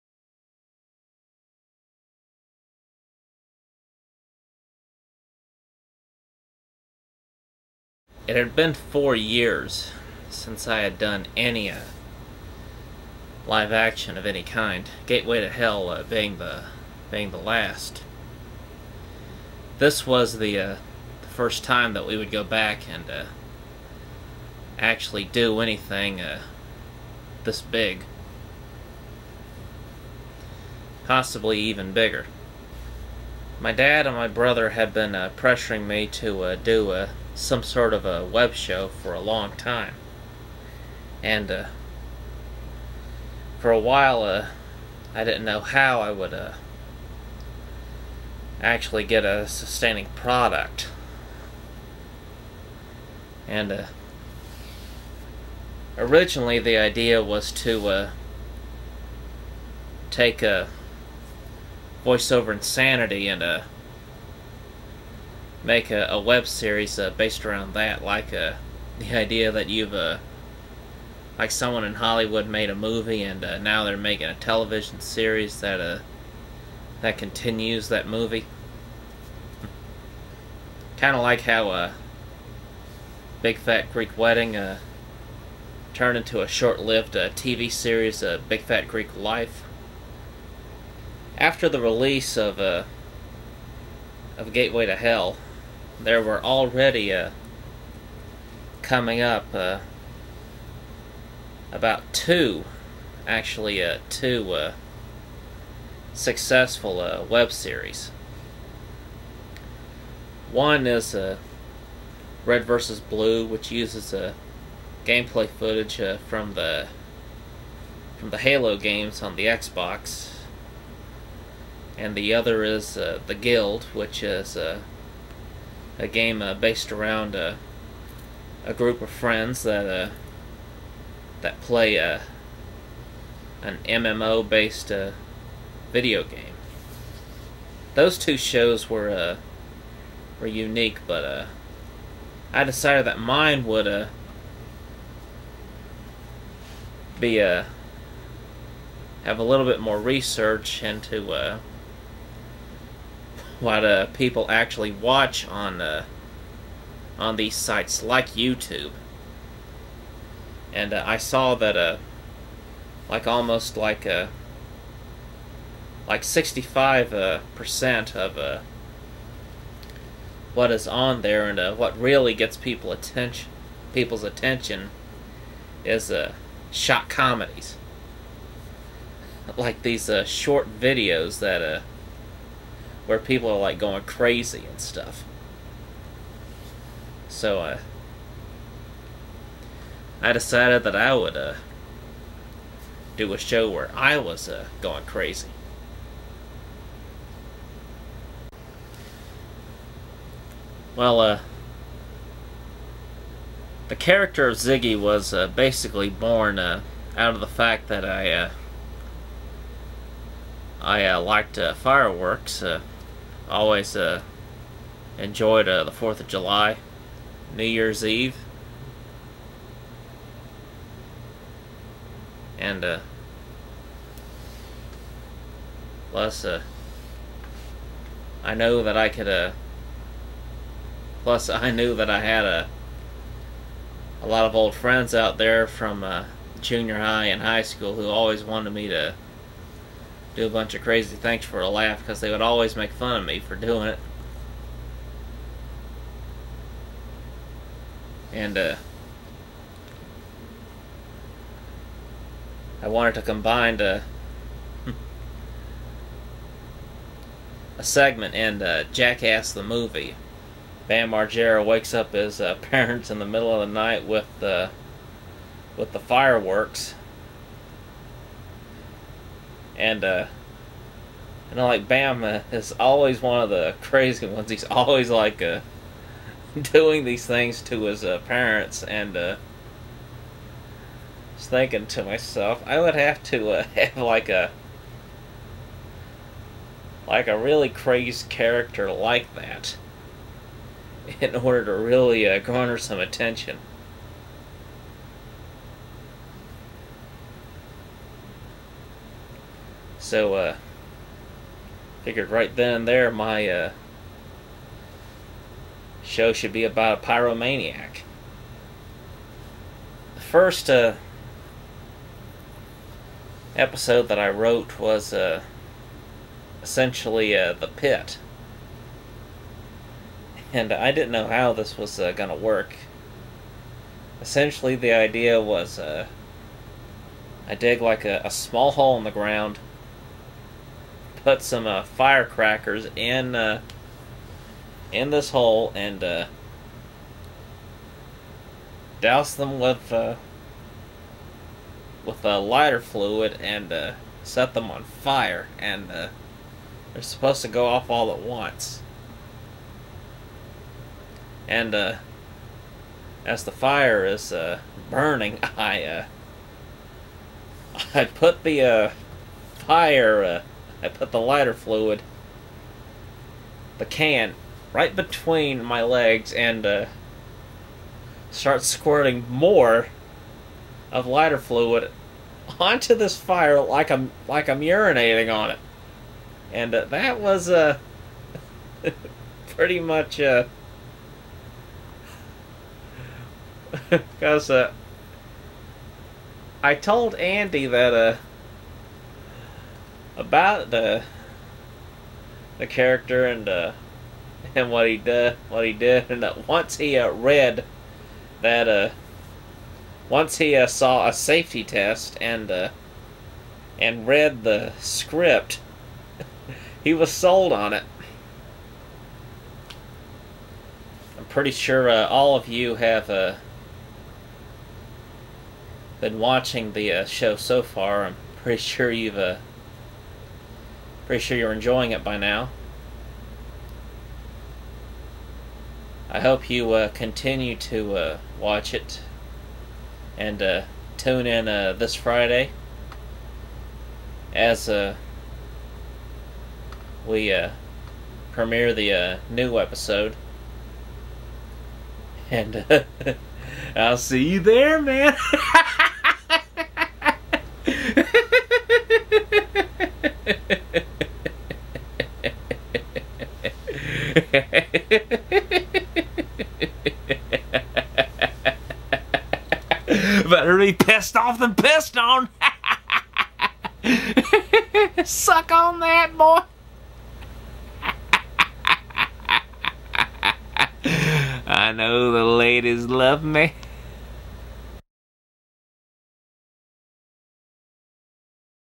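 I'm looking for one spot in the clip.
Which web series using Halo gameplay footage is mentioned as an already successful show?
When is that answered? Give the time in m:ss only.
1:52.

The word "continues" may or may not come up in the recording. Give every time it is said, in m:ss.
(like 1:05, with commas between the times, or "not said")
1:17, 7:06.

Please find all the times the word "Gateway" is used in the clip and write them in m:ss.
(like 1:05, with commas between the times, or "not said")
0:15, 1:34.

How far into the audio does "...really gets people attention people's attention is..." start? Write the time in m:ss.
2:51.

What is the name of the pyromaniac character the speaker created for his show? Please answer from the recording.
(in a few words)
Ziggy.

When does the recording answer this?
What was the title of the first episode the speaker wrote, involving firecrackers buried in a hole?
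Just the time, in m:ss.
5:17.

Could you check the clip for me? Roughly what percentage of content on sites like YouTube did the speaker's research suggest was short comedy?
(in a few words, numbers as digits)
65 percent.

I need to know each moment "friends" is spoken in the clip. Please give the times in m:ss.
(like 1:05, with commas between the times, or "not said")
2:09, 3:54.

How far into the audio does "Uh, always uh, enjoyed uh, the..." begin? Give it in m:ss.
3:32.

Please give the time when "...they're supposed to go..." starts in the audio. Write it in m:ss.
5:46.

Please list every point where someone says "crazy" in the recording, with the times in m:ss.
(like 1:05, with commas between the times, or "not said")
3:04, 3:15, 4:00, 4:33, 4:47.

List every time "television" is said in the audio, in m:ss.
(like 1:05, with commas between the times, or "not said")
1:14.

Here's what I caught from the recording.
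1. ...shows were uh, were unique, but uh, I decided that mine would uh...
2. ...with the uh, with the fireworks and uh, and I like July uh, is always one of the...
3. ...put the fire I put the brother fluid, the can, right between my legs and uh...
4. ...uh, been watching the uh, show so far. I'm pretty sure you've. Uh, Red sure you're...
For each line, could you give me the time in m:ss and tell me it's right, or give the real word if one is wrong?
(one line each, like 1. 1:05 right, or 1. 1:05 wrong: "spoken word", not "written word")
1. 2:18 right
2. 4:24 wrong: "Bama", not "July"
3. 5:58 wrong: "lighter", not "brother"
4. 6:53 wrong: "Pretty", not "Red".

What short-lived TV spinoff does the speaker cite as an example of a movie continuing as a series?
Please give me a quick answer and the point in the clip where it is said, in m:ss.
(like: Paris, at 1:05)
Big Fat Greek Life, at 1:28.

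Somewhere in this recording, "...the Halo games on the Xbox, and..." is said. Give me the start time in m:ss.
1:58.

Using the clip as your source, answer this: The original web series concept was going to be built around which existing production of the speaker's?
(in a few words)
Voiceover Insanity.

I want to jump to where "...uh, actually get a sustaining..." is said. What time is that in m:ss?
0:46.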